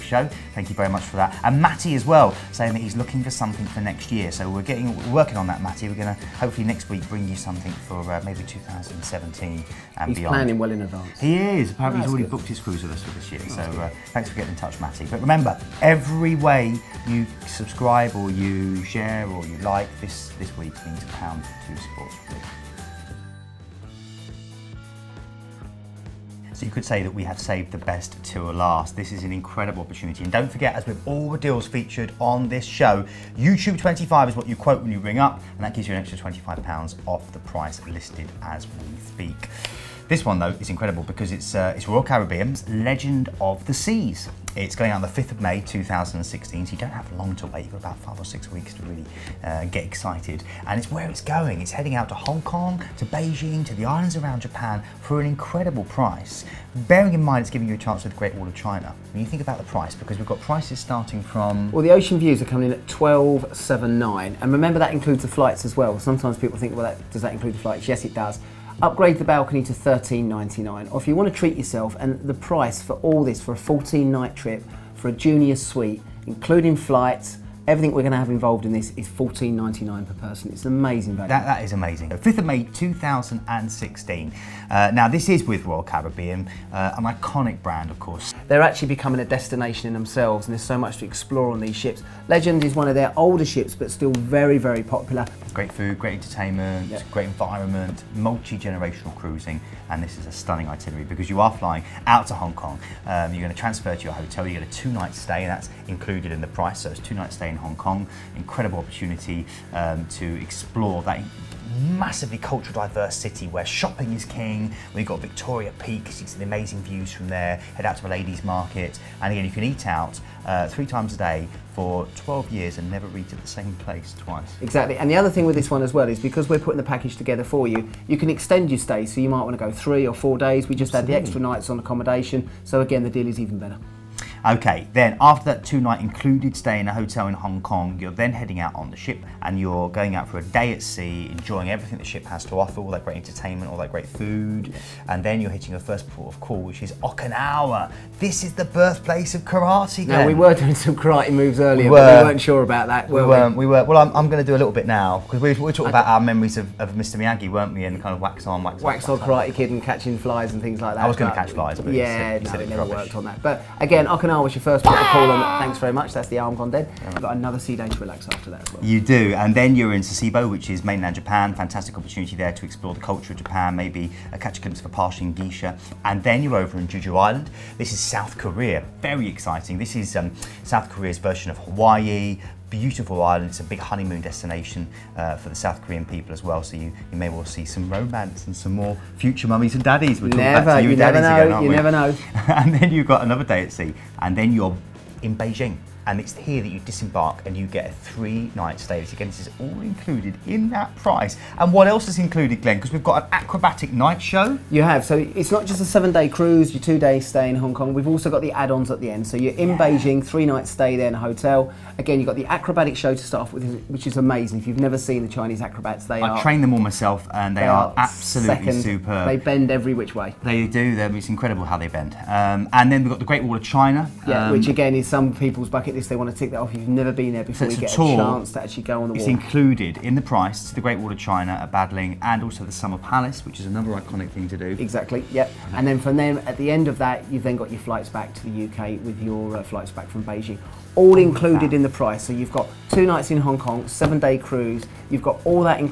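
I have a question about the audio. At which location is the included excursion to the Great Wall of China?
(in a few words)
Badaling.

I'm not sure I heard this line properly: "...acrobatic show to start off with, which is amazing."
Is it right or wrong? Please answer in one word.
right.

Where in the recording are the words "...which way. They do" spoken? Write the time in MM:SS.
03:39.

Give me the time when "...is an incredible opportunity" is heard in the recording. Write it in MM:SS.
00:29.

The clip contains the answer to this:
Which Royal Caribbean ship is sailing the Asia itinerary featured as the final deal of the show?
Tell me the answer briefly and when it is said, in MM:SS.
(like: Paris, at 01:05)
Legend of the Seas, at 00:42.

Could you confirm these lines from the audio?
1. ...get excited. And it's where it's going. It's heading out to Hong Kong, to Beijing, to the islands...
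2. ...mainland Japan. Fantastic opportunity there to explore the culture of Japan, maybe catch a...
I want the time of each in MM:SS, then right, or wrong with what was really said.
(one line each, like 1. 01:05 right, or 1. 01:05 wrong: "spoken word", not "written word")
1. 00:49 right
2. 02:50 right.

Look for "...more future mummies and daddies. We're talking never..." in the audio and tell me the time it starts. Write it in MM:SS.
03:08.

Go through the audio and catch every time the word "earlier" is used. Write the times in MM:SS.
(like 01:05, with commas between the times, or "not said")
02:31.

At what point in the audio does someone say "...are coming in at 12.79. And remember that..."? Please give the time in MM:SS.
01:02.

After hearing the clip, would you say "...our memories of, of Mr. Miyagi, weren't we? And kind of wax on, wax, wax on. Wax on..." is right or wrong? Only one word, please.
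right.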